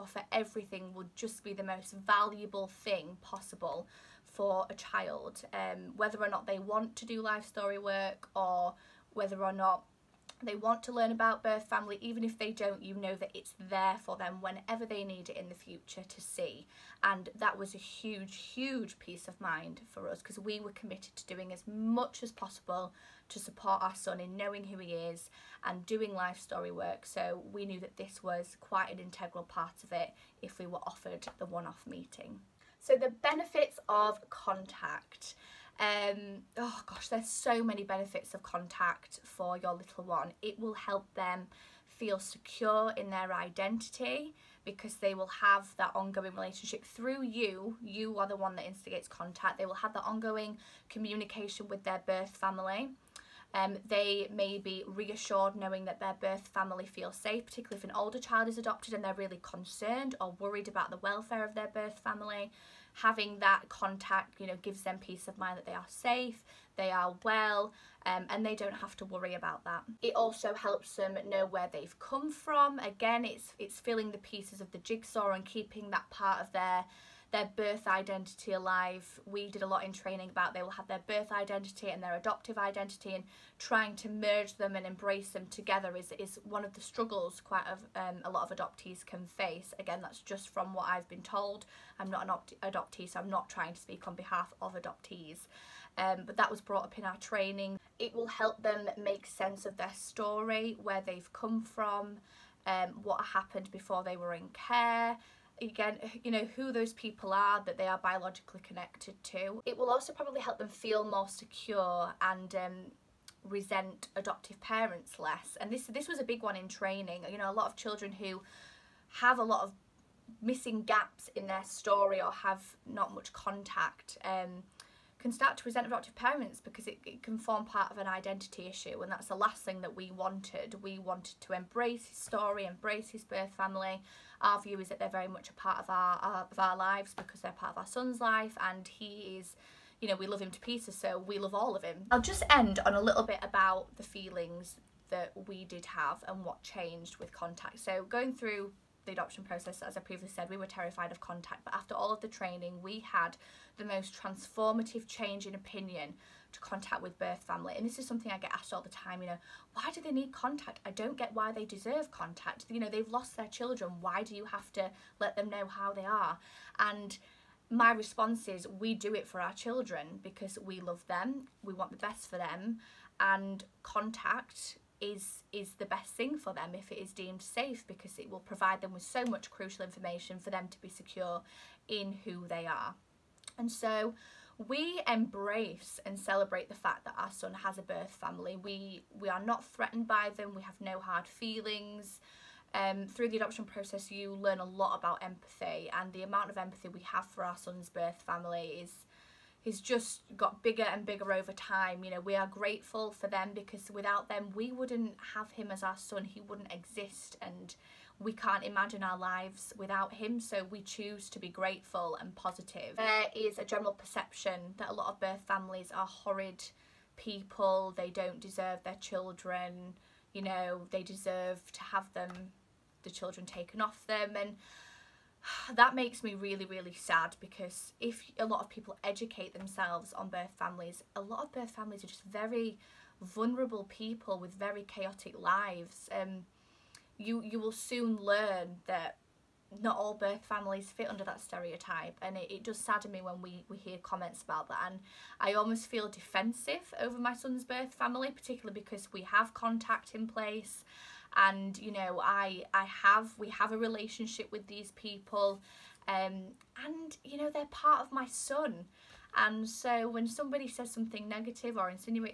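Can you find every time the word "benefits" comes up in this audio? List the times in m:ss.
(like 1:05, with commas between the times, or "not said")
0:33, 0:37.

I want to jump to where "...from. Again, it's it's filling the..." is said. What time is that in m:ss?
1:12.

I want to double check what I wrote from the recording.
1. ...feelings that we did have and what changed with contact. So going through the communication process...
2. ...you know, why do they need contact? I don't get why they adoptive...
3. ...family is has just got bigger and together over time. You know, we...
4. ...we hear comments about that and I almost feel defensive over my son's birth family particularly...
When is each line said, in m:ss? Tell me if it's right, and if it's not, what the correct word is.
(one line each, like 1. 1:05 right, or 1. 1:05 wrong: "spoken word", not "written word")
1. 2:24 wrong: "adoption", not "communication"
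2. 2:39 wrong: "deserve", not "adoptive"
3. 3:18 wrong: "bigger", not "together"
4. 4:03 right.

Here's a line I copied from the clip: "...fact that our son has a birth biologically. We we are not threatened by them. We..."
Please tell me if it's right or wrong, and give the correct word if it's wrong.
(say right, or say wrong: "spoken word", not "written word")
wrong: "family", not "biologically".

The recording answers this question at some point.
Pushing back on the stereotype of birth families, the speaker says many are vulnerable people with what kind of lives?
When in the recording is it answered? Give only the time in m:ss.
3:54.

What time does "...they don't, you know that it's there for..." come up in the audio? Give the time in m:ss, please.
0:12.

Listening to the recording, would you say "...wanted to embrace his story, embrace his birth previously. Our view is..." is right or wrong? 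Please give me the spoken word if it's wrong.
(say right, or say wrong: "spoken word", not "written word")
wrong: "family", not "previously".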